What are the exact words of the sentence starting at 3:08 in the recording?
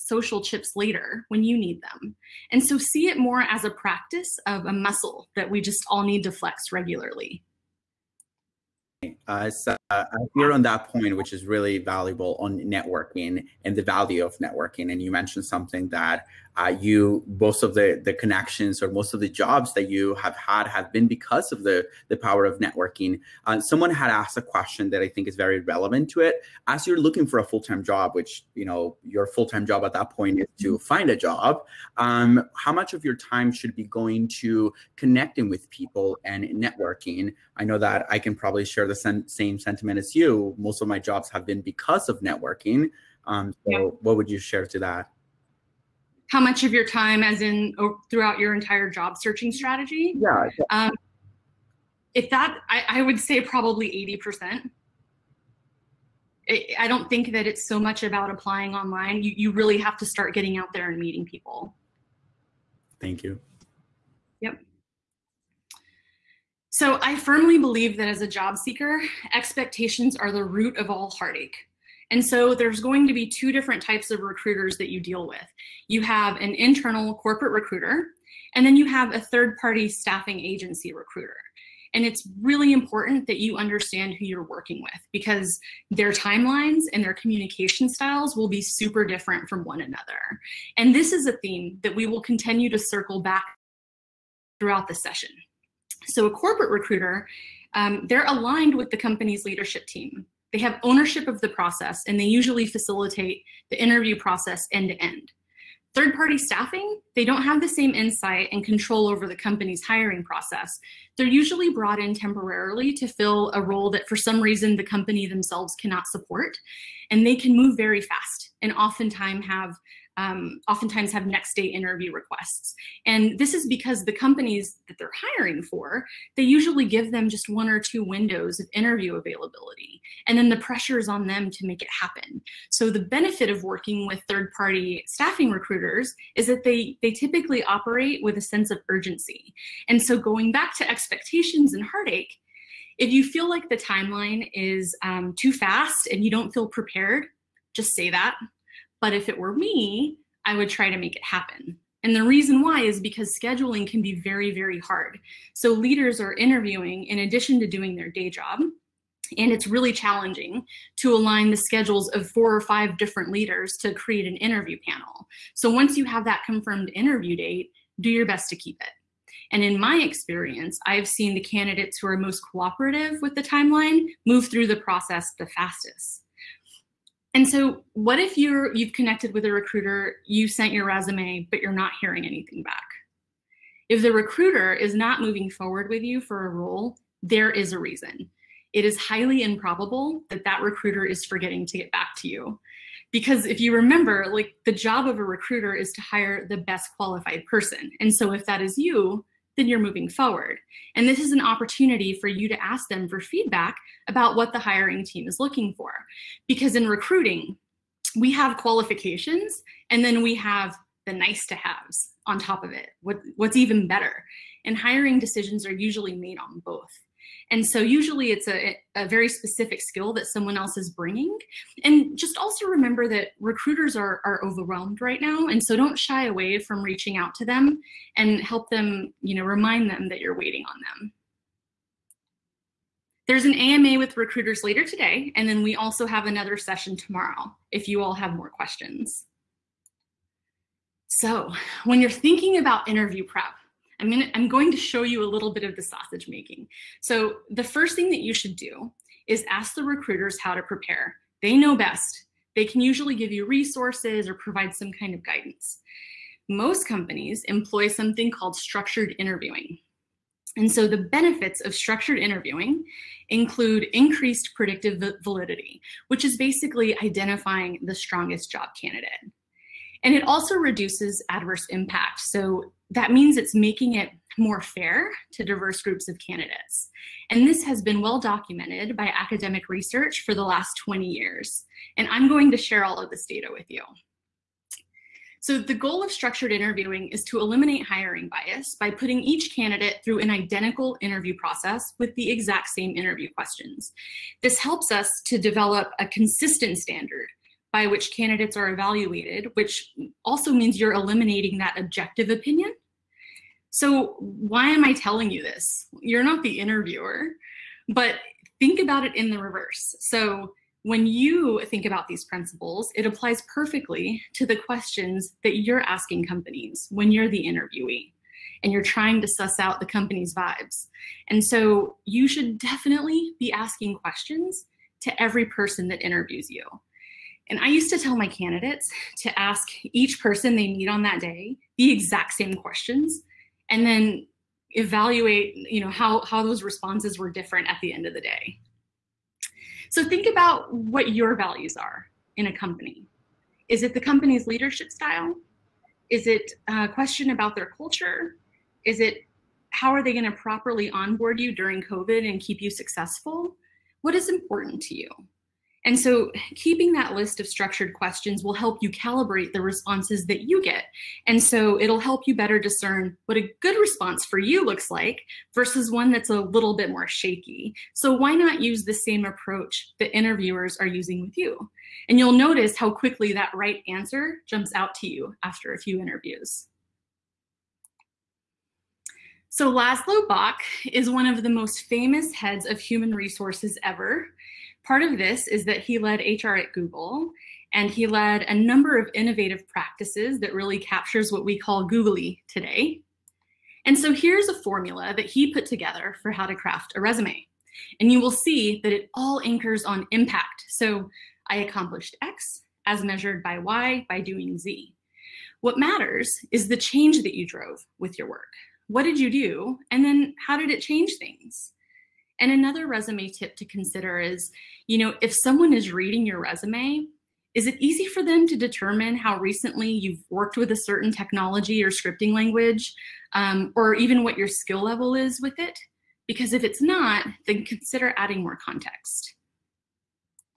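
It is highly improbable that that recruiter is forgetting to get back to you.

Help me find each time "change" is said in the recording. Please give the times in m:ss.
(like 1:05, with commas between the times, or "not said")
6:46, 6:50.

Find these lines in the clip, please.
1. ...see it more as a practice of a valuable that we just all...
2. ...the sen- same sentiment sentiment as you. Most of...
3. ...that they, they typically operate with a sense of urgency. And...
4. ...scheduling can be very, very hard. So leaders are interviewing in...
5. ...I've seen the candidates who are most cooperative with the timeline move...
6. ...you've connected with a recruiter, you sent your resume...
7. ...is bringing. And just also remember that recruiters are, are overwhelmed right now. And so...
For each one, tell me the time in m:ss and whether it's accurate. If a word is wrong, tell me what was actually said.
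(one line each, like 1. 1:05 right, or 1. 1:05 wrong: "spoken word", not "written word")
1. 0:02 wrong: "muscle", not "valuable"
2. 0:38 right
3. 2:16 right
4. 2:33 right
5. 2:50 right
6. 2:58 right
7. 3:40 right.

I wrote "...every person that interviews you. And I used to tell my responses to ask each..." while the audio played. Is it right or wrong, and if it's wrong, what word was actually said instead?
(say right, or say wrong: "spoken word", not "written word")
wrong: "candidates", not "responses".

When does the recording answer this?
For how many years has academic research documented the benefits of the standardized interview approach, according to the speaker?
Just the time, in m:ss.
4:40.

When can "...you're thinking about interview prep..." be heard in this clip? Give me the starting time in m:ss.
4:02.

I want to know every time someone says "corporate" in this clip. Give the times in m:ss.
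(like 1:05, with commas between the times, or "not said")
1:17, 1:36.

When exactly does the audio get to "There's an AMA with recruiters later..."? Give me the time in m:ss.
3:53.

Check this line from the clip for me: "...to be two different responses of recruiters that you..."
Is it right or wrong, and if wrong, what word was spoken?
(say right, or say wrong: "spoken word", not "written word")
wrong: "types", not "responses".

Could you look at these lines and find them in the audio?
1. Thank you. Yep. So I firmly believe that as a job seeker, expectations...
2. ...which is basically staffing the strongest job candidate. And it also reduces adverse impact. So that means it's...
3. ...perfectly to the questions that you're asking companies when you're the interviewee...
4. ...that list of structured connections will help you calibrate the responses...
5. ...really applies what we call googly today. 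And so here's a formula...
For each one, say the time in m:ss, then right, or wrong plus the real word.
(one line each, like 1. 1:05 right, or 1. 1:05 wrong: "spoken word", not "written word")
1. 1:03 right
2. 4:26 wrong: "identifying", not "staffing"
3. 5:13 right
4. 5:56 wrong: "questions", not "connections"
5. 6:30 wrong: "captures", not "applies".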